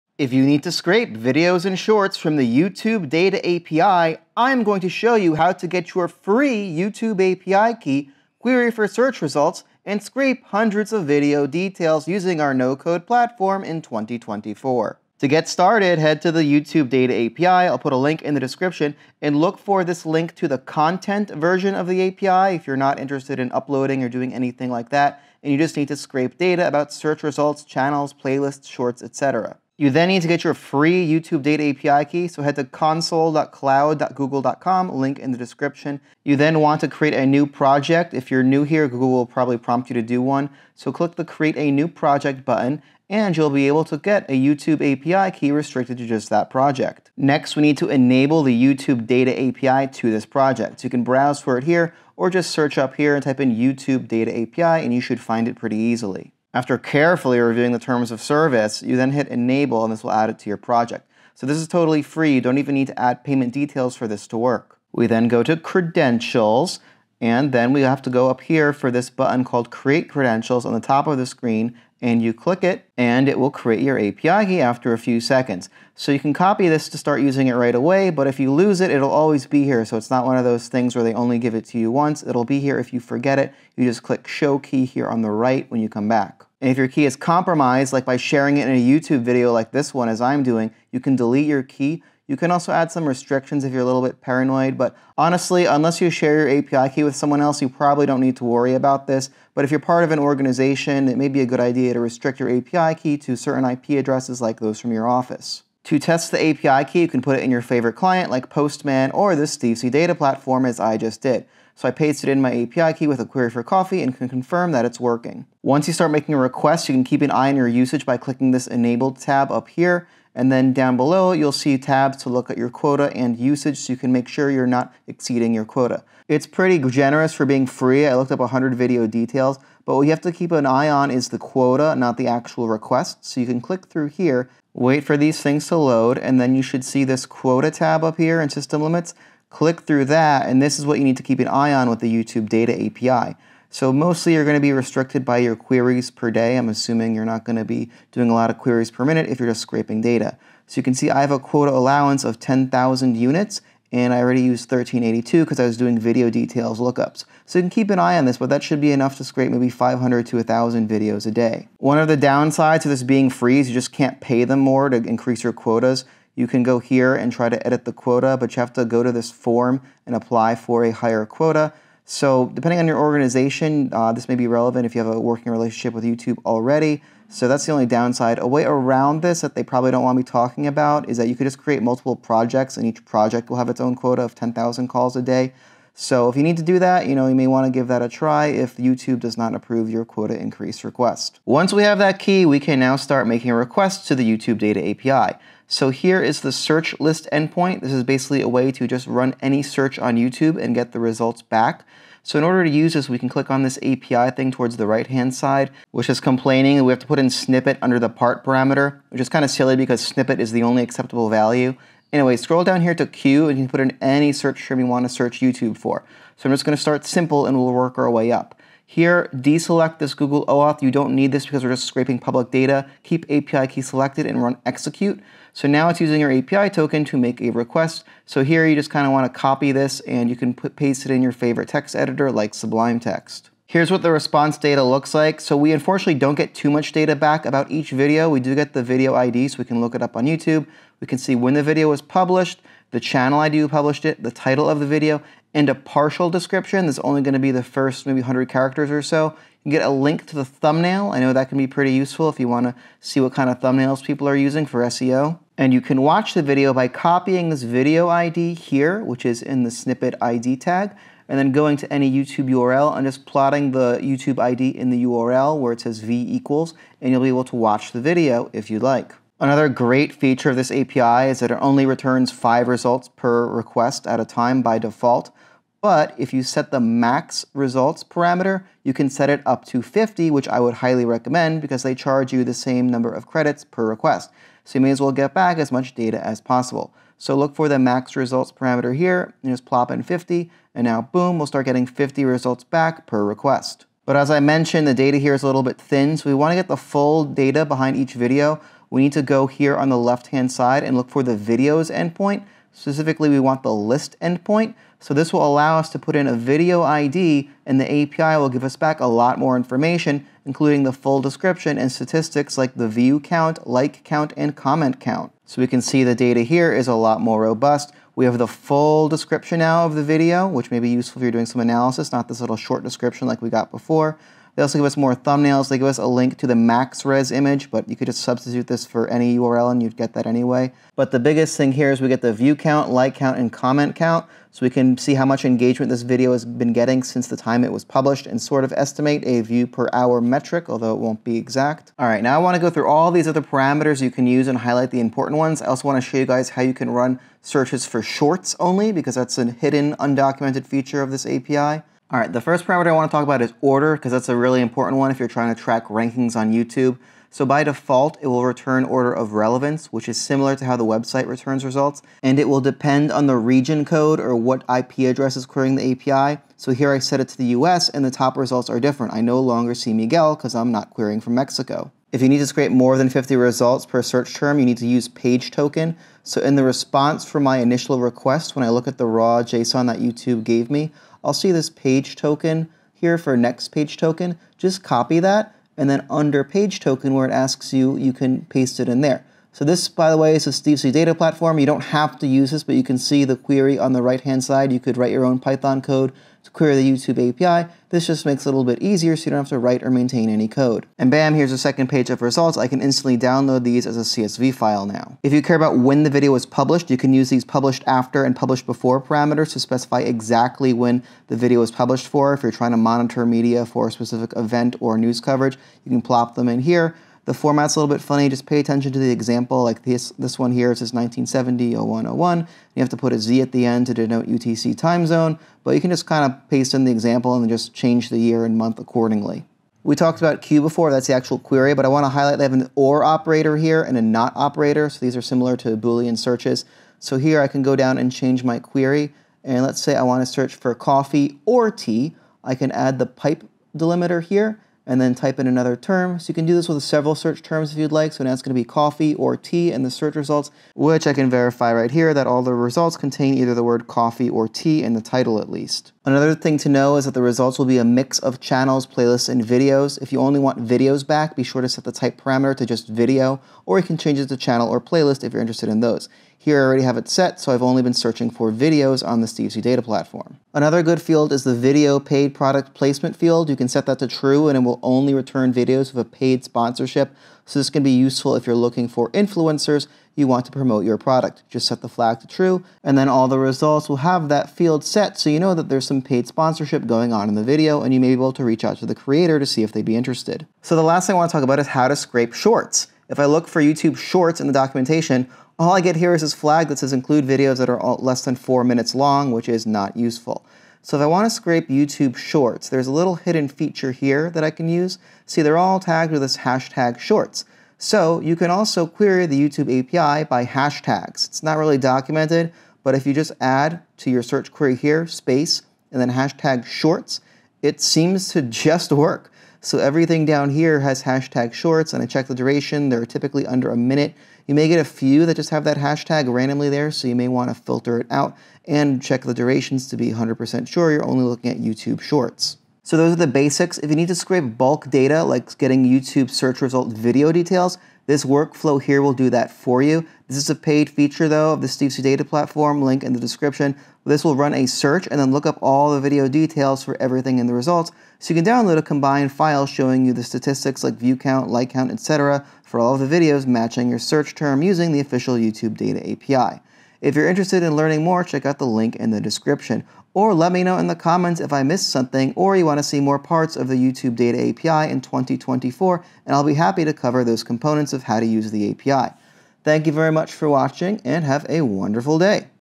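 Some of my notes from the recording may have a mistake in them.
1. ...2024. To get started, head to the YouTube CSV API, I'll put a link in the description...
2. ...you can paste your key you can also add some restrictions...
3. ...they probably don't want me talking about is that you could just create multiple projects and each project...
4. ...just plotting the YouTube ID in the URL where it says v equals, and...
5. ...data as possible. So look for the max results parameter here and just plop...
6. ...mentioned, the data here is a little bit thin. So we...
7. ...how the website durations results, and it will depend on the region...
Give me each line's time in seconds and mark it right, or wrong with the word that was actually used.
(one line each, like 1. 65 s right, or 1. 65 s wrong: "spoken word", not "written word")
1. 13 s wrong: "Data", not "CSV"
2. 90 s wrong: "delete", not "paste"
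3. 179 s right
4. 263 s right
5. 285 s right
6. 294 s right
7. 360 s wrong: "returns", not "durations".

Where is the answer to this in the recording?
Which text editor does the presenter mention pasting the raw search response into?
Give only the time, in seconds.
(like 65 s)
232 s.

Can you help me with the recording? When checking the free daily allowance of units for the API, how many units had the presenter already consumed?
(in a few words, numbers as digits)
1382.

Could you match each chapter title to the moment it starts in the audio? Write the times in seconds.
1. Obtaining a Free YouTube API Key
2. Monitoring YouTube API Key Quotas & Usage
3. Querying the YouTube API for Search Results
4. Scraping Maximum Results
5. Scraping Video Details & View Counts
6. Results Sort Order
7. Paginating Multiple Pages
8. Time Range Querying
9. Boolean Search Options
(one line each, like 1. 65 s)
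1. 30 s
2. 115 s
3. 191 s
4. 276 s
5. 295 s
6. 342 s
7. 377 s
8. 405 s
9. 430 s.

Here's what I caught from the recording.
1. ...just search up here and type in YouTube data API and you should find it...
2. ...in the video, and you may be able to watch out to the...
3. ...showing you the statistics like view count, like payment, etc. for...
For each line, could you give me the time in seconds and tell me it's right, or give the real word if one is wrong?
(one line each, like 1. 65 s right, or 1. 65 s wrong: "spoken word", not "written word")
1. 52 s right
2. 487 s wrong: "reach", not "watch"
3. 549 s wrong: "count", not "payment".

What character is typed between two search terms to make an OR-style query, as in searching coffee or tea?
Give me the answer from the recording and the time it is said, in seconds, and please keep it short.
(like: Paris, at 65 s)
pipe, at 443 s.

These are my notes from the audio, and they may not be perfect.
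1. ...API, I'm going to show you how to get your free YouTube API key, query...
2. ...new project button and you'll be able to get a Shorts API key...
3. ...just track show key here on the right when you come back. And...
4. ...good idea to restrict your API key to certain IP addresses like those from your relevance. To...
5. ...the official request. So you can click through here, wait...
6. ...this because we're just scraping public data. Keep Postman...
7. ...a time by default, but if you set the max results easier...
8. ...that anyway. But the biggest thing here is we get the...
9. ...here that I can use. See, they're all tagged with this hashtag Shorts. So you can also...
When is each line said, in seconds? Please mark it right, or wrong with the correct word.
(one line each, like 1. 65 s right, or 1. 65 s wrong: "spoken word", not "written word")
1. 3 s right
2. 41 s wrong: "YouTube", not "Shorts"
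3. 83 s wrong: "click", not "track"
4. 101 s wrong: "office", not "relevance"
5. 132 s wrong: "actual", not "official"
6. 221 s wrong: "API", not "Postman"
7. 274 s wrong: "parameter", not "easier"
8. 330 s right
9. 503 s right.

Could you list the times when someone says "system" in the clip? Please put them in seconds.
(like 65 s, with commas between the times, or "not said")
138 s.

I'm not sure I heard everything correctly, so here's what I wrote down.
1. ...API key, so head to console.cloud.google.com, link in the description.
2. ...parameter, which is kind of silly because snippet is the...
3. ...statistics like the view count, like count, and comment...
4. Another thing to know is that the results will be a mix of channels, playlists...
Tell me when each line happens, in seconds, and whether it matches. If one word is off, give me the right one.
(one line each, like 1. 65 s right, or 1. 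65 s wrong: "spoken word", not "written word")
1. 31 s right
2. 208 s right
3. 311 s right
4. 456 s right.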